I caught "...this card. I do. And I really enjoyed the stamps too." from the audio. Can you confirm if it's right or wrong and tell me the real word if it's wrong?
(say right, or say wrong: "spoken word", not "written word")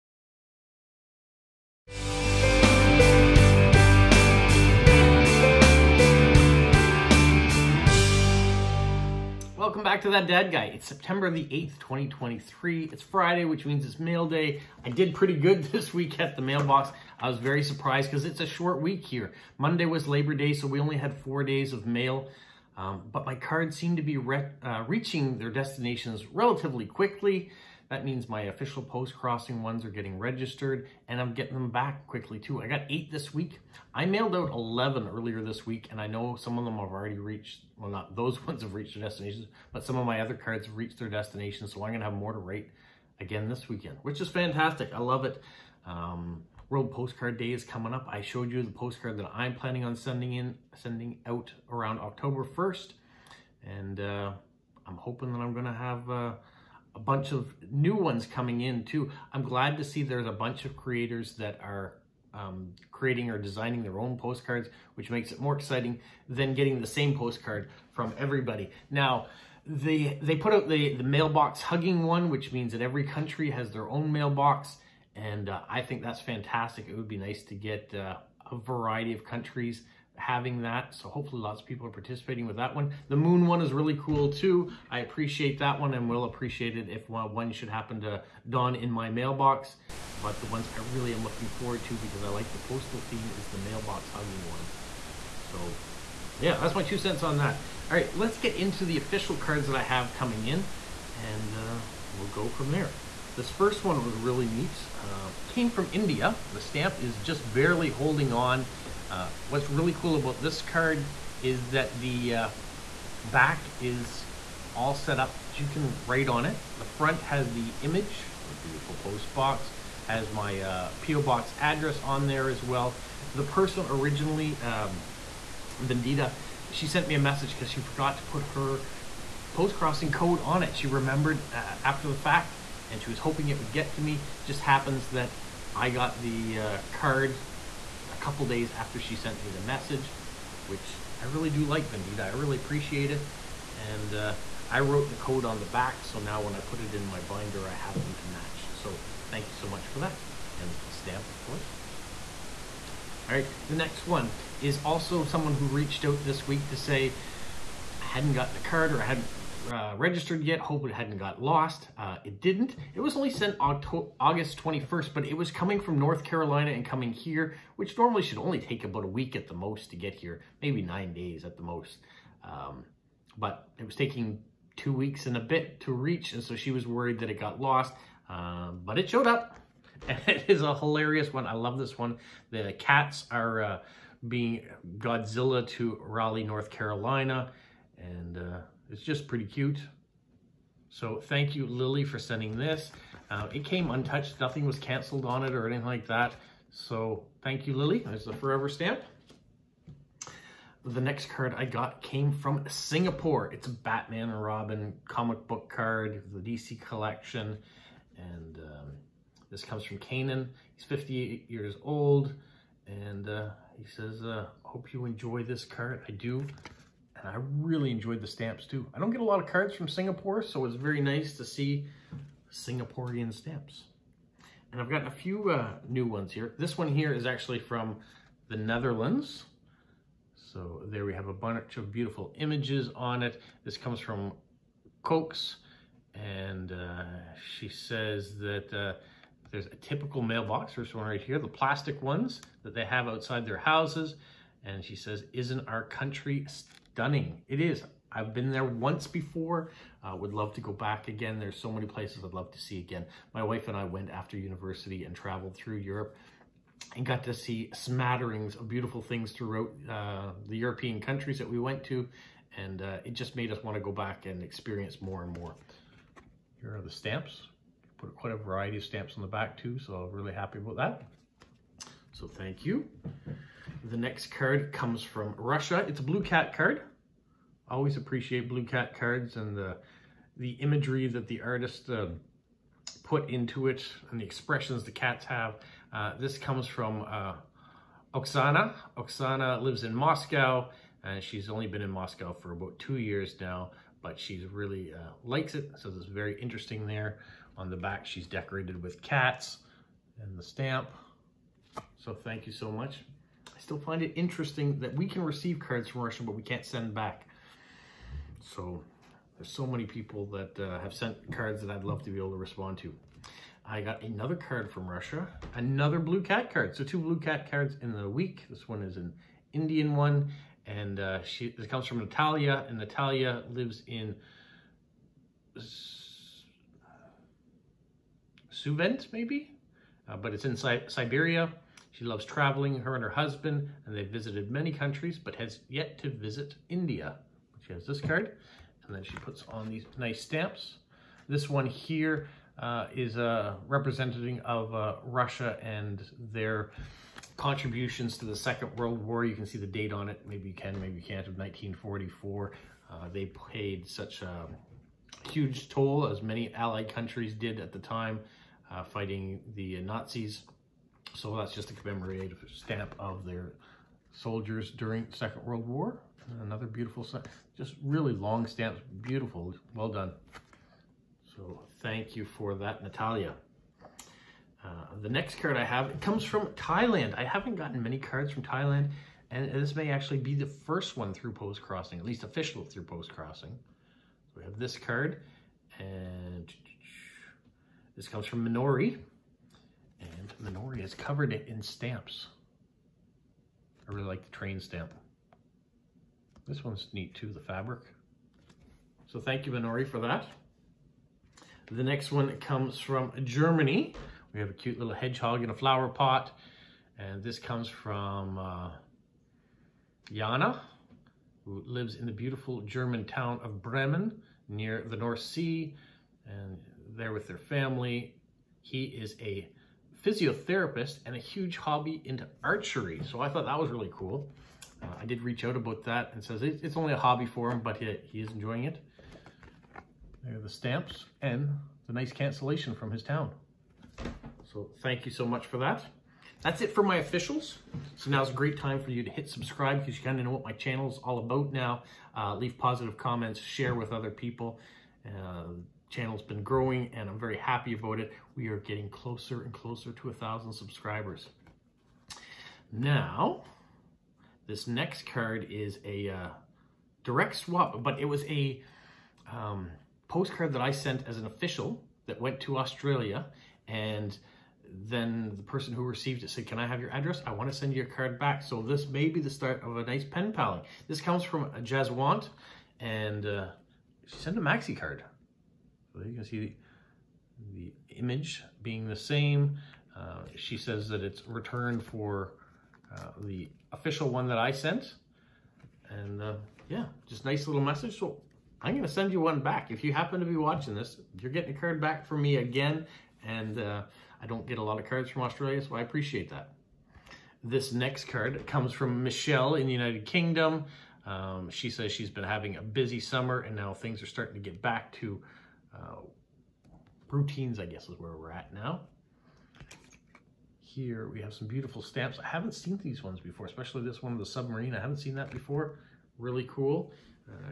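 right.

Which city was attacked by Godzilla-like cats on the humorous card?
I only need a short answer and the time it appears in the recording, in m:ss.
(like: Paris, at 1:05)
Raleigh, at 3:06.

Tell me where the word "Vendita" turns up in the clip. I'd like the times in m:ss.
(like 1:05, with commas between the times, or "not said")
2:05, 2:21.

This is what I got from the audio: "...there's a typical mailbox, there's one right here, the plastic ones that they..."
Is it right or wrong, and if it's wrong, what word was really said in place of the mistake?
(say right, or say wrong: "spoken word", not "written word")
right.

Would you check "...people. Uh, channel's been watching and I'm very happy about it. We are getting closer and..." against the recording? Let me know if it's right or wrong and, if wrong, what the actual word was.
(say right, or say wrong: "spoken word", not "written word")
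wrong: "growing", not "watching".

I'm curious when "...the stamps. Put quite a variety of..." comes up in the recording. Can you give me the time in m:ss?
4:26.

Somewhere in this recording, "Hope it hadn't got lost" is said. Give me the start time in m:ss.
2:40.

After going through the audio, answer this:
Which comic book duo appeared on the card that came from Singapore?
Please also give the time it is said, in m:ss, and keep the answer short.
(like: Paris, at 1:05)
Batman and Robin, at 3:23.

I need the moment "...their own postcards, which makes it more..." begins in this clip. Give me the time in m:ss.
1:03.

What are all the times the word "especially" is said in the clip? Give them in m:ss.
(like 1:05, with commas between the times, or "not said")
8:33.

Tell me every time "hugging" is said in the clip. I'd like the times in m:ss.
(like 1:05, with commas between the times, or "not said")
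1:11, 1:34.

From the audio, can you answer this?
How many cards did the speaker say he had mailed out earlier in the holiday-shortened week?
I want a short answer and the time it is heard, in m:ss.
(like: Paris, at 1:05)
11, at 0:33.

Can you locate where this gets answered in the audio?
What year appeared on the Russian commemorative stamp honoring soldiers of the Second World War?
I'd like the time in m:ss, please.
5:51.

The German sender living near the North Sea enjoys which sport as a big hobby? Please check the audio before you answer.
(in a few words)
Archery.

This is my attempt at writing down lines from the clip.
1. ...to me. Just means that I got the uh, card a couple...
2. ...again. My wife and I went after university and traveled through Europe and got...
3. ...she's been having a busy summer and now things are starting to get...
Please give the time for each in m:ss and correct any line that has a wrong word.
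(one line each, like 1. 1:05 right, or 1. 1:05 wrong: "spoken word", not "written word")
1. 2:13 wrong: "happens", not "means"
2. 4:12 right
3. 8:21 right.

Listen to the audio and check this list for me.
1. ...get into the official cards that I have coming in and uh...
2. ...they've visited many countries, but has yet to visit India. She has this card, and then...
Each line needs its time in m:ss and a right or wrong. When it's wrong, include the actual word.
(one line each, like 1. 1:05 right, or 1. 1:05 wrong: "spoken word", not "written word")
1. 1:38 right
2. 5:33 right.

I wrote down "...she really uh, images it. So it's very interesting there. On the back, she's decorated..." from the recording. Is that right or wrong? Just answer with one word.
wrong.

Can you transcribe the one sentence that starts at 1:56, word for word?
The front has the image, the beautiful post box, has my uh, P.O.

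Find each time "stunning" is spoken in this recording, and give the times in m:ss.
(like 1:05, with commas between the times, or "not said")
4:06.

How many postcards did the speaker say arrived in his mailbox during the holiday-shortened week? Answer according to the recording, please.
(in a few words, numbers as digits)
8.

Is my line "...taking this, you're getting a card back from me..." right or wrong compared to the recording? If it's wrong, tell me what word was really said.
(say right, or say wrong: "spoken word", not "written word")
wrong: "watching", not "taking".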